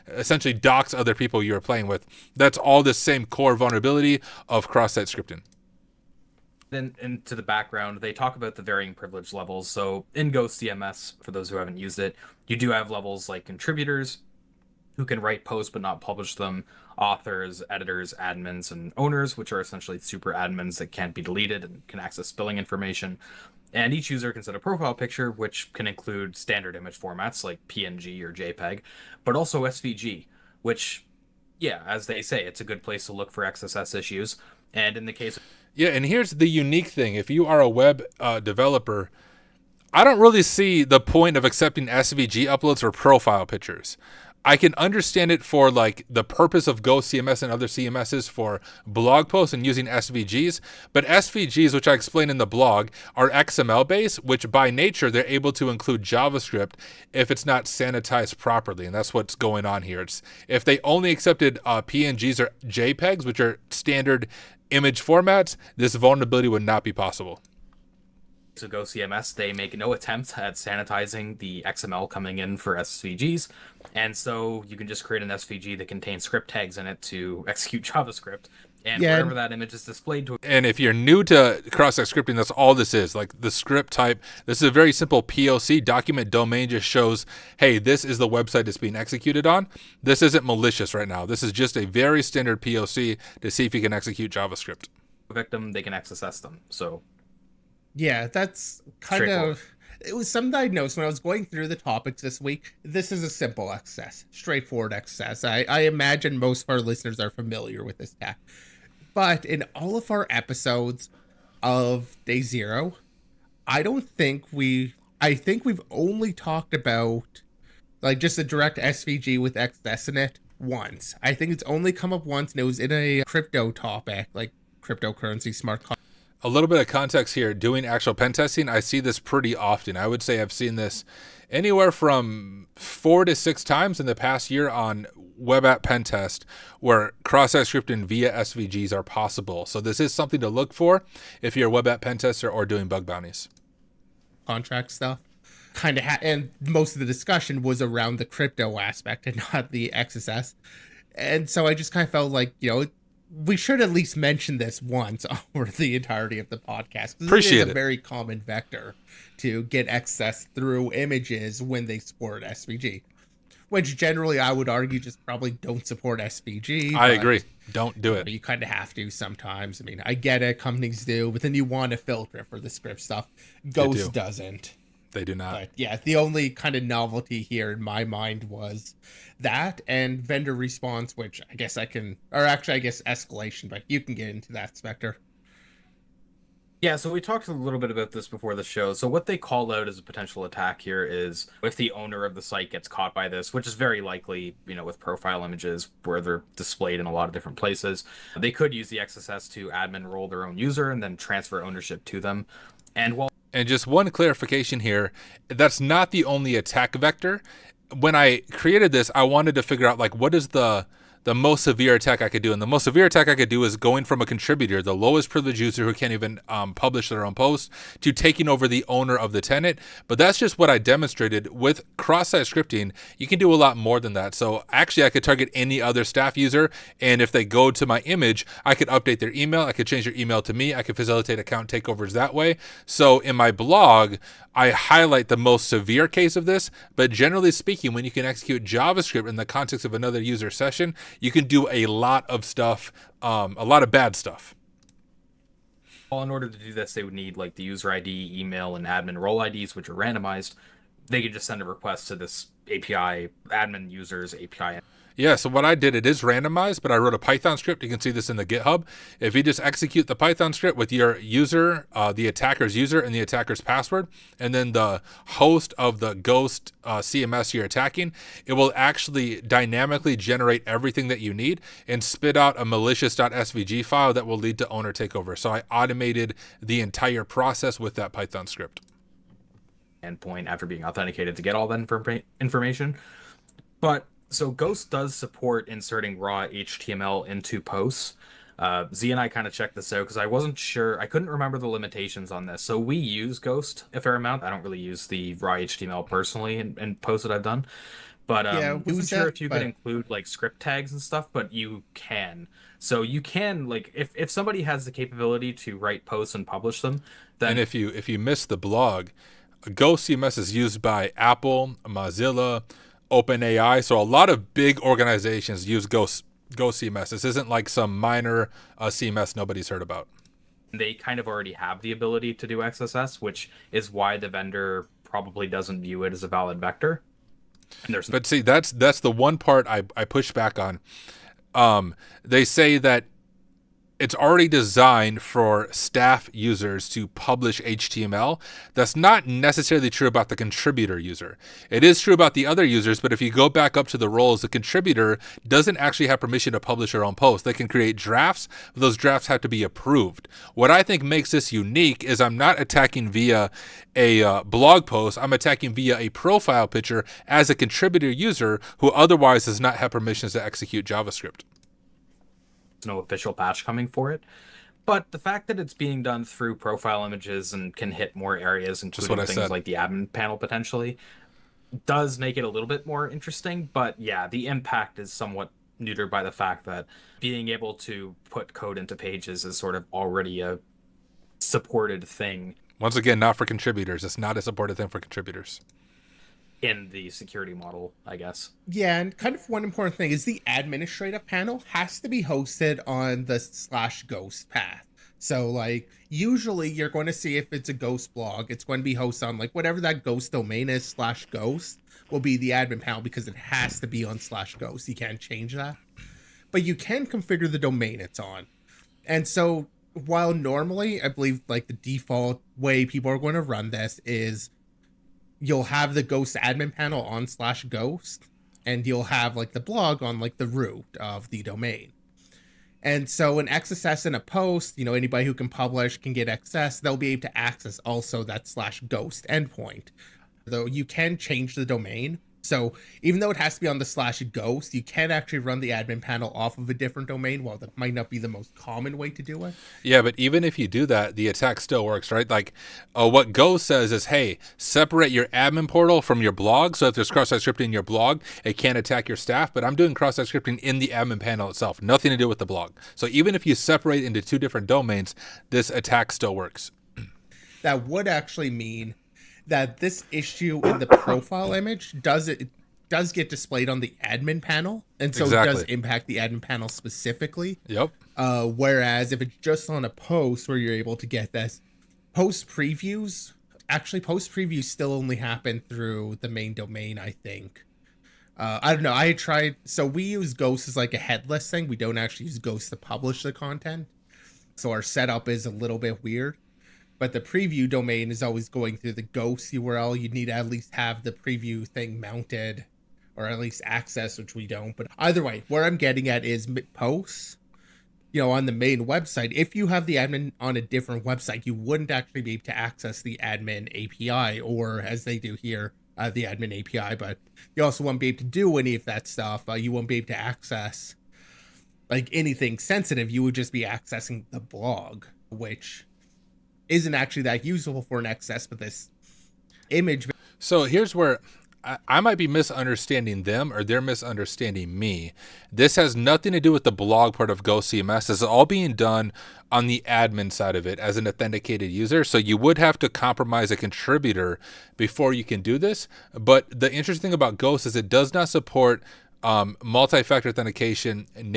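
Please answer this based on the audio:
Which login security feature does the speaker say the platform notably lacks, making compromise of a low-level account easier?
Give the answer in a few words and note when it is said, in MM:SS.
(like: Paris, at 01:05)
Multi-factor authentication, at 08:59.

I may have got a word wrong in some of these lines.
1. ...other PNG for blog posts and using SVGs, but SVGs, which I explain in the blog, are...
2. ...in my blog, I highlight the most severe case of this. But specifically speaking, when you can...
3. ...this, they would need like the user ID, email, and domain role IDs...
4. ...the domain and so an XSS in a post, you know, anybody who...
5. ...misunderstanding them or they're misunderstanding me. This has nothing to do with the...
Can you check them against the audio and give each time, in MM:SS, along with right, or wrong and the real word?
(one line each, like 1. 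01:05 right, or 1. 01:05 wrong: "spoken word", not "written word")
1. 00:47 wrong: "CMSs", not "PNG"
2. 03:53 wrong: "generally", not "specifically"
3. 04:06 wrong: "admin", not "domain"
4. 07:01 right
5. 08:42 right.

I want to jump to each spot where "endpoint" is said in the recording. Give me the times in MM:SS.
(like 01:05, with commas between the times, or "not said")
04:40, 07:09.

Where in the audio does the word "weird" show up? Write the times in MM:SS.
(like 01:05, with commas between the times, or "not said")
08:06.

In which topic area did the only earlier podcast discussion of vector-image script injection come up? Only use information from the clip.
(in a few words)
Cryptocurrency smart contract.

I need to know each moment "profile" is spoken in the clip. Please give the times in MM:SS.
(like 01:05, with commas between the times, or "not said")
00:24, 00:42, 03:14, 05:56, 06:06, 07:40.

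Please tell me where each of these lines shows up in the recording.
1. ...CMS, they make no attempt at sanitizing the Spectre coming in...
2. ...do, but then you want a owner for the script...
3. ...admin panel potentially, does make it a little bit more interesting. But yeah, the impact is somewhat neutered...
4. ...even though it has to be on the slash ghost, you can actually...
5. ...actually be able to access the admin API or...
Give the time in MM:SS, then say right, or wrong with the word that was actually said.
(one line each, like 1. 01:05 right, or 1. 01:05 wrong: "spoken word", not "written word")
1. 01:08 wrong: "XML", not "Spectre"
2. 02:51 wrong: "filter", not "owner"
3. 06:09 right
4. 07:13 right
5. 08:21 right.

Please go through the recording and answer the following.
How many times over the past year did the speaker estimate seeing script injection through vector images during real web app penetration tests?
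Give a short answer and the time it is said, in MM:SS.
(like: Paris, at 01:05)
4 to 6, at 02:12.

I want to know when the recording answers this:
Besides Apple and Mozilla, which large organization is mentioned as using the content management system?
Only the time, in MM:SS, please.
05:13.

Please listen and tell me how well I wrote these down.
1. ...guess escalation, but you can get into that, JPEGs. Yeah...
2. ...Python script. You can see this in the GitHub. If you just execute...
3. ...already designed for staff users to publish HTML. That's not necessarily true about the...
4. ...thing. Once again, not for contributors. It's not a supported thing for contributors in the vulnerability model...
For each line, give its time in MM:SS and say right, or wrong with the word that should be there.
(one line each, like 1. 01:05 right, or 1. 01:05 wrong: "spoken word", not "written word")
1. 03:02 wrong: "Spectre", not "JPEGs"
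2. 04:17 right
3. 05:34 right
4. 06:22 wrong: "security", not "vulnerability".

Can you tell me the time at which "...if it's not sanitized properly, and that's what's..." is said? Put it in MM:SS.
00:57.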